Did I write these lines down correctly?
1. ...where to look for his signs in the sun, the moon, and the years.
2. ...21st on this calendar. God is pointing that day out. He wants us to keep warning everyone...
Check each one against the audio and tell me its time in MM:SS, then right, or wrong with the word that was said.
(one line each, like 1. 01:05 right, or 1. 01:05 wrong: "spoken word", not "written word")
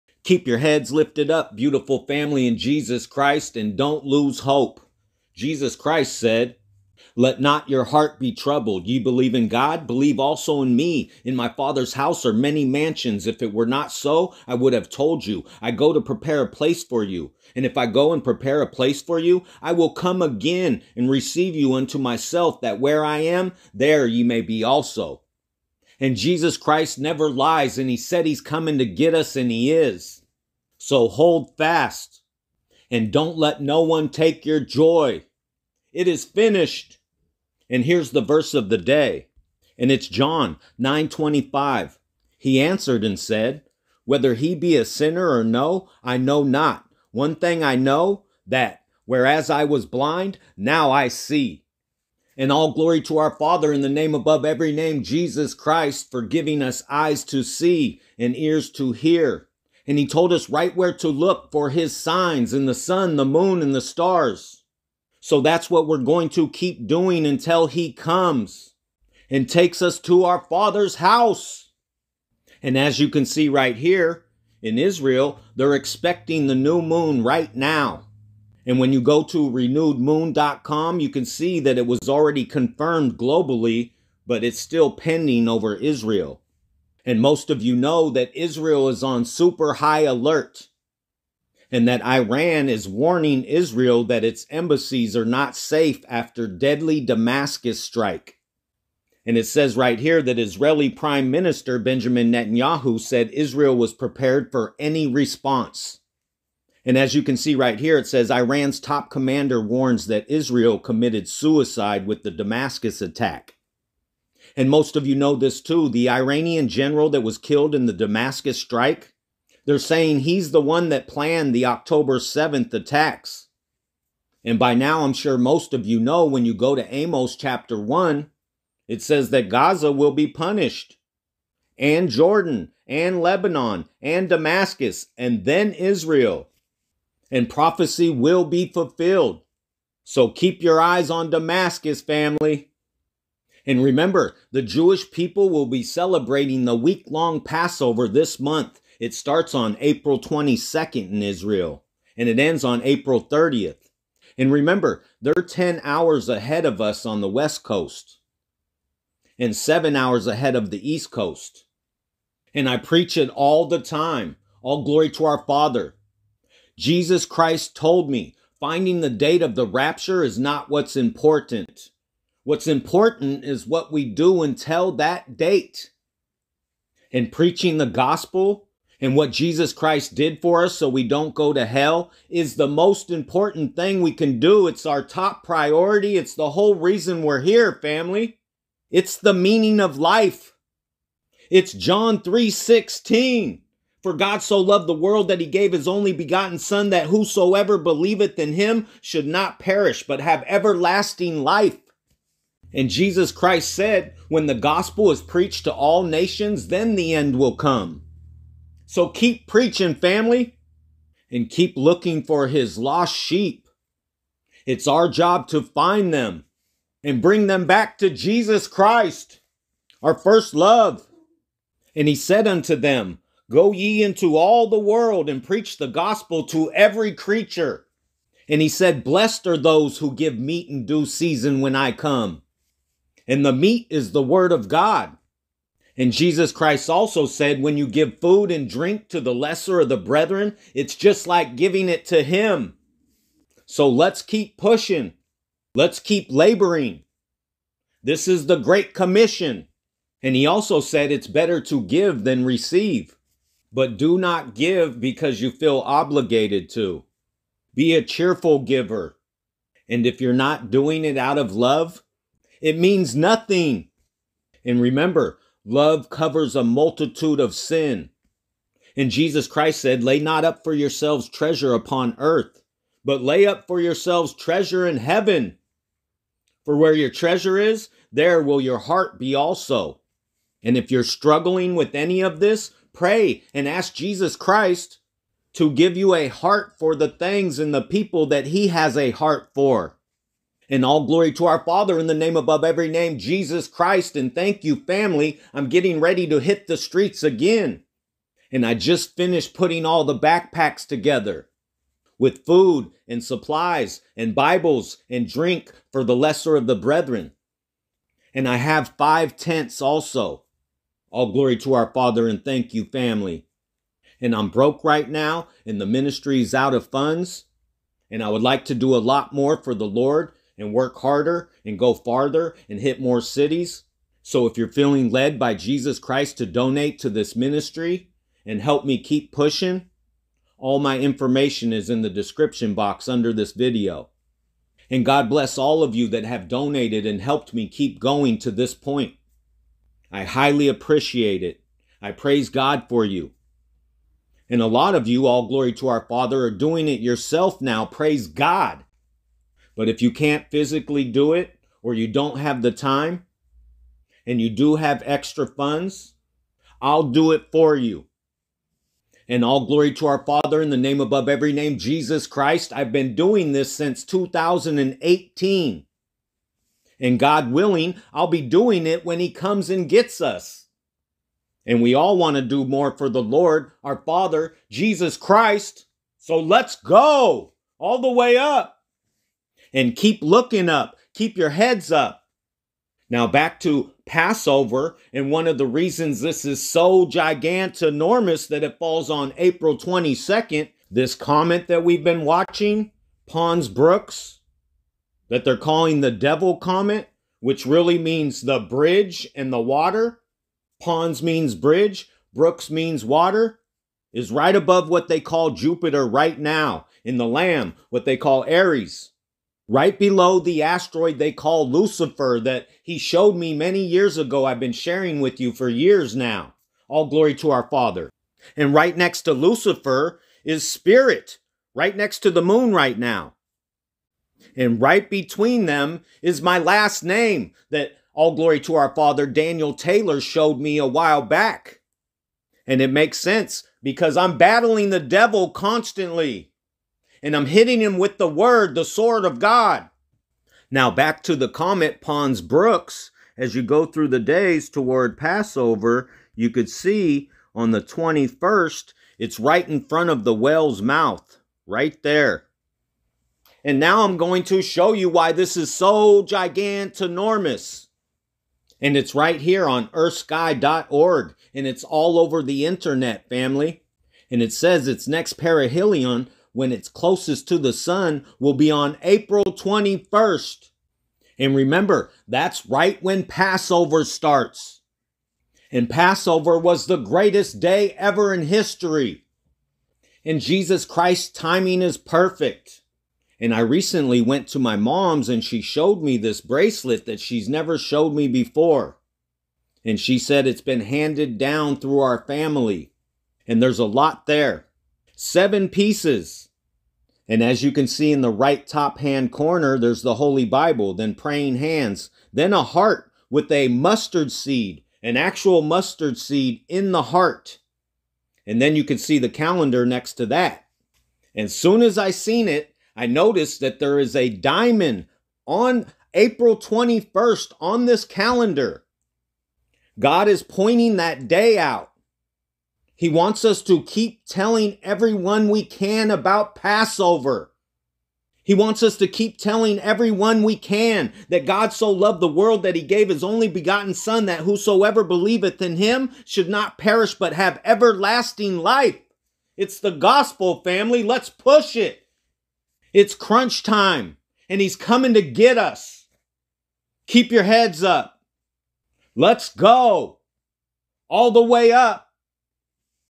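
1. 01:00 wrong: "stars", not "years"
2. 08:36 wrong: "telling", not "warning".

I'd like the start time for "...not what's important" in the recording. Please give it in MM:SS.
02:50.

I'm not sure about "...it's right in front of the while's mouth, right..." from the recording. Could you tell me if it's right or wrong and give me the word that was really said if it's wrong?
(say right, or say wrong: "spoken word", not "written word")
wrong: "whale", not "while".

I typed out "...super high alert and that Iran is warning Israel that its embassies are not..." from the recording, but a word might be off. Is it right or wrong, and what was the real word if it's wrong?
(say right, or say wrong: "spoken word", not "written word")
right.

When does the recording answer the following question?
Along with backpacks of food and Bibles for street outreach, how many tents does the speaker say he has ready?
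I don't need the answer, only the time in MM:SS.
05:08.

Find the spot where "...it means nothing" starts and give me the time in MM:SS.
04:22.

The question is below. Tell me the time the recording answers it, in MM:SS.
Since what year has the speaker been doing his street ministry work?
06:04.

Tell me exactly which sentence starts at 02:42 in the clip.
And I preach it all the time.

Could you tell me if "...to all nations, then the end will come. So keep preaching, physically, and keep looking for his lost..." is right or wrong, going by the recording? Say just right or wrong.
wrong.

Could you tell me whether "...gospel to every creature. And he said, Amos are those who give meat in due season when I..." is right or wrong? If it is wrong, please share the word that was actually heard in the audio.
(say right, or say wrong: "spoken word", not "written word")
wrong: "Blessed", not "Amos".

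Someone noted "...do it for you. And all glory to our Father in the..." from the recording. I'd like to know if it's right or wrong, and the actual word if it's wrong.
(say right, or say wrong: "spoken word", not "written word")
right.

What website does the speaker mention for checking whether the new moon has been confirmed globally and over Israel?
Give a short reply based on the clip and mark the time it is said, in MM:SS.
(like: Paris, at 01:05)
renewedmoon.com, at 01:19.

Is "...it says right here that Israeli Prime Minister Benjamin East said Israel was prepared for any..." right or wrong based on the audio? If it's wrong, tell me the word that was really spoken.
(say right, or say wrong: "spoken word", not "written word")
wrong: "Netanyahu", not "East".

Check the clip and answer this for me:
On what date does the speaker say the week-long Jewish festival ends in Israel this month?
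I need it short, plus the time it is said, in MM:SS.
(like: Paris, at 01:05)
April 30, at 02:32.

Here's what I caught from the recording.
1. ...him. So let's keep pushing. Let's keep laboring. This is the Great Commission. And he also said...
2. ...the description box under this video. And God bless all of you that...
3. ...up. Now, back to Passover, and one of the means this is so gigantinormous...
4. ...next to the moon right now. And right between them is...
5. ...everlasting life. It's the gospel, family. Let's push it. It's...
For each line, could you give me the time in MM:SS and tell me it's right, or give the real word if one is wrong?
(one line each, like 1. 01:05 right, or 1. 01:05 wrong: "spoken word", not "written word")
1. 04:02 right
2. 05:32 right
3. 06:21 wrong: "reasons", not "means"
4. 07:01 right
5. 08:57 right.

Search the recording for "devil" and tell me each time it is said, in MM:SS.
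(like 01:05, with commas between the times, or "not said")
06:36, 07:14.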